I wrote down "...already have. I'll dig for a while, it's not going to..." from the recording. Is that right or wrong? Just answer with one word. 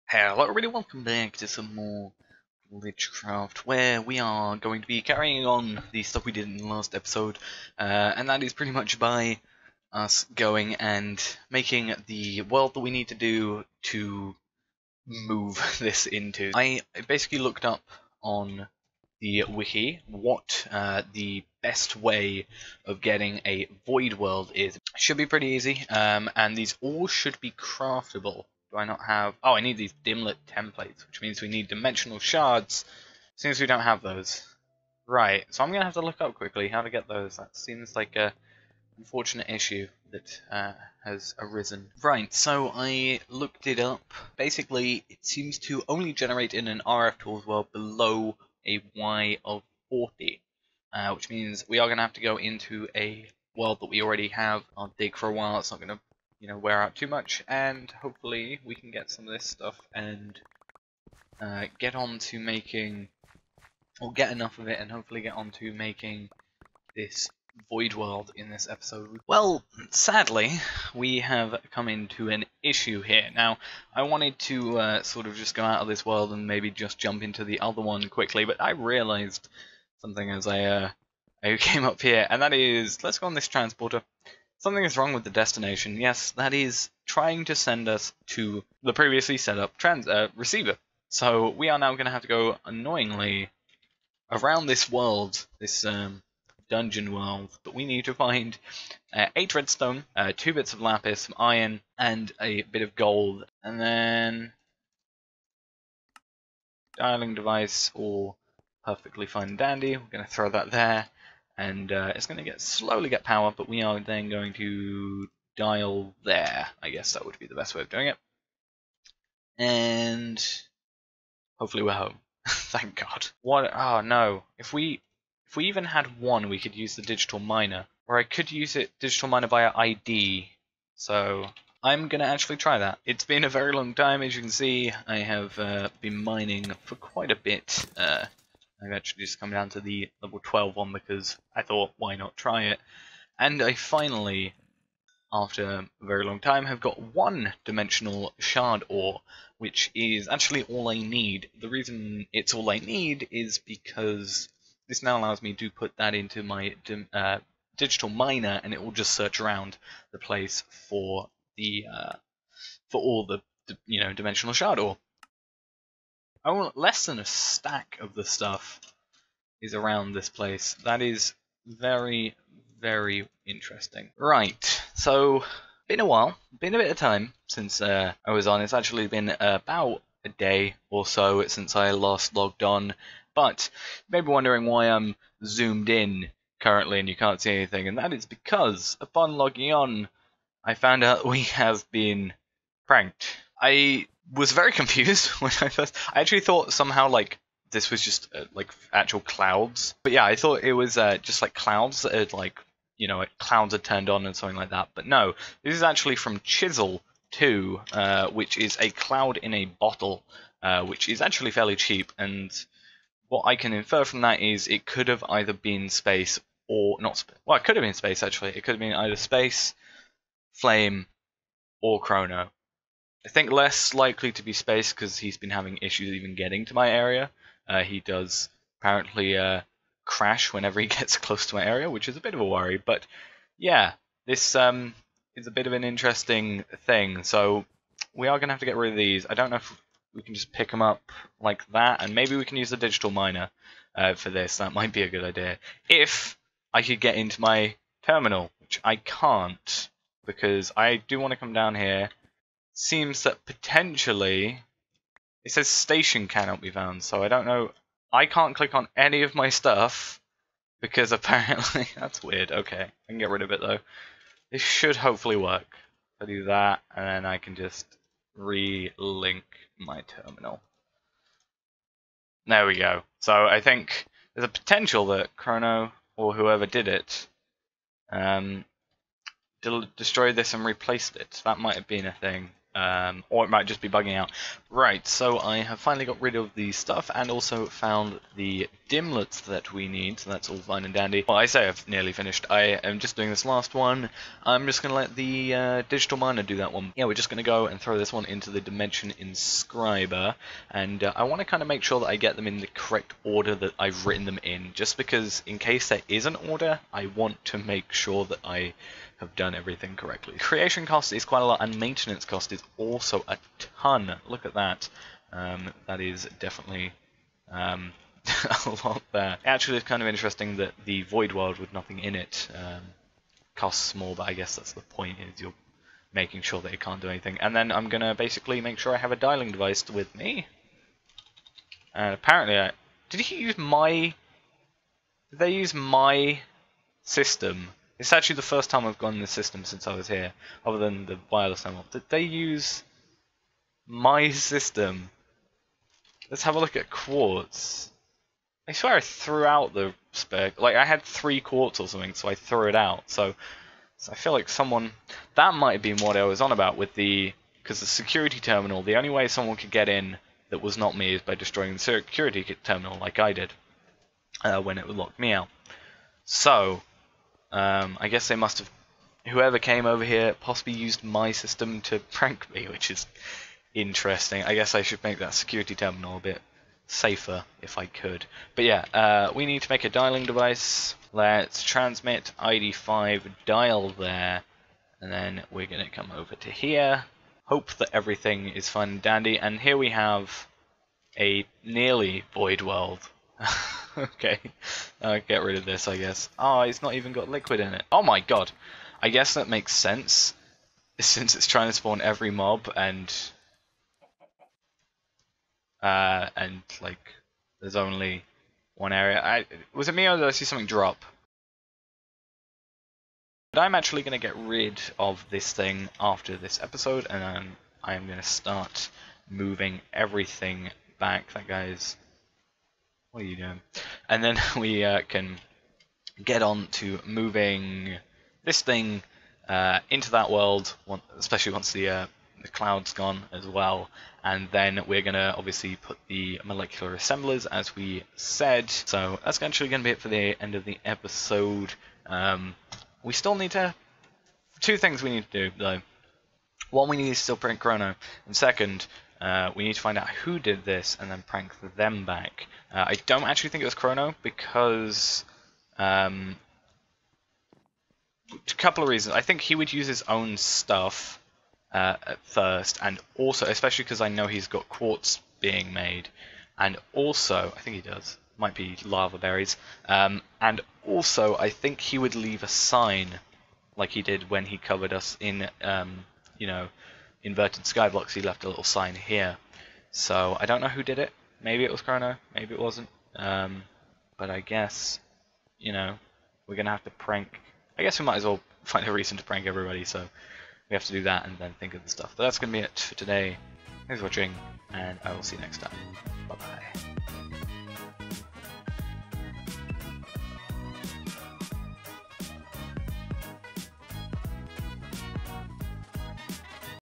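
right.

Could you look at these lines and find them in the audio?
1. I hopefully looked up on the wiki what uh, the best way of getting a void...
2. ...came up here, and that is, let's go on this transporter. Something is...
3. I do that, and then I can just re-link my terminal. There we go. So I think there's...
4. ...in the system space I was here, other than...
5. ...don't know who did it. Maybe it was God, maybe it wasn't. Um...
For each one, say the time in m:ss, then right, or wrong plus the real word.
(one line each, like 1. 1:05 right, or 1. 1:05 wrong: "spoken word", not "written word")
1. 0:16 wrong: "basically", not "hopefully"
2. 1:21 right
3. 4:26 right
4. 5:39 wrong: "since", not "space"
5. 8:00 wrong: "Chronno", not "God".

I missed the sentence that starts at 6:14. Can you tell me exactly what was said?
I guess I should make that security terminal a bit safer if I could.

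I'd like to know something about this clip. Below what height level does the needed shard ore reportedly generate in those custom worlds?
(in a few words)
Y of 40.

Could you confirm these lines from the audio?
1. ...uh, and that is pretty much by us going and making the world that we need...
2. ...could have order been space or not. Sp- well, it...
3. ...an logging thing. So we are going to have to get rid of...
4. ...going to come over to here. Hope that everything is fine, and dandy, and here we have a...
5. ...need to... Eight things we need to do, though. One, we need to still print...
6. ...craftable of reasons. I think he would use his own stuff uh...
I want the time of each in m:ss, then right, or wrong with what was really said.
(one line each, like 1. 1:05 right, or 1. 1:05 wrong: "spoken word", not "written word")
1. 0:07 right
2. 3:34 wrong: "either", not "order"
3. 3:55 wrong: "interesting", not "logging"
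4. 6:25 right
5. 7:23 wrong: "Two", not "Eight"
6. 7:38 wrong: "couple", not "craftable".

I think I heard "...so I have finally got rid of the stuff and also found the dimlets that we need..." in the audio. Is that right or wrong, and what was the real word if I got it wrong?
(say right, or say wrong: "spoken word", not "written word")
right.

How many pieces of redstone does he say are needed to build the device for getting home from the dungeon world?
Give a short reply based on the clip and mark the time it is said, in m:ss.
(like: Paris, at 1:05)
8, at 1:39.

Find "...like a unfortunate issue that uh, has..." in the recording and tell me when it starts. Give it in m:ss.
0:37.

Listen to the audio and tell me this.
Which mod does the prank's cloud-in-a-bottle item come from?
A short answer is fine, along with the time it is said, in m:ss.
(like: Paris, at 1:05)
Chisel Two, at 3:26.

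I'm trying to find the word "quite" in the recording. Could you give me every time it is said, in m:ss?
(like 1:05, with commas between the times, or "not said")
2:16, 5:11.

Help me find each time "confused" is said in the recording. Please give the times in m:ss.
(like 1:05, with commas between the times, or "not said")
3:14.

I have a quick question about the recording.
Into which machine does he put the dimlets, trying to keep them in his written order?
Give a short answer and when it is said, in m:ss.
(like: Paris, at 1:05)
dimension inscriber, at 4:58.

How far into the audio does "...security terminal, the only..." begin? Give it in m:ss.
5:57.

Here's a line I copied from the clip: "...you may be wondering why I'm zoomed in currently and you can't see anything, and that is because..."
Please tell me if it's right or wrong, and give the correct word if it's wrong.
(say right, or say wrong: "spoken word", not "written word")
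right.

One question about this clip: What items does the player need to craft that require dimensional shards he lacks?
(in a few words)
dimlet templates.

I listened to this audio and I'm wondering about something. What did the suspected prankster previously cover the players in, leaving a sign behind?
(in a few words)
inverted skyblocks.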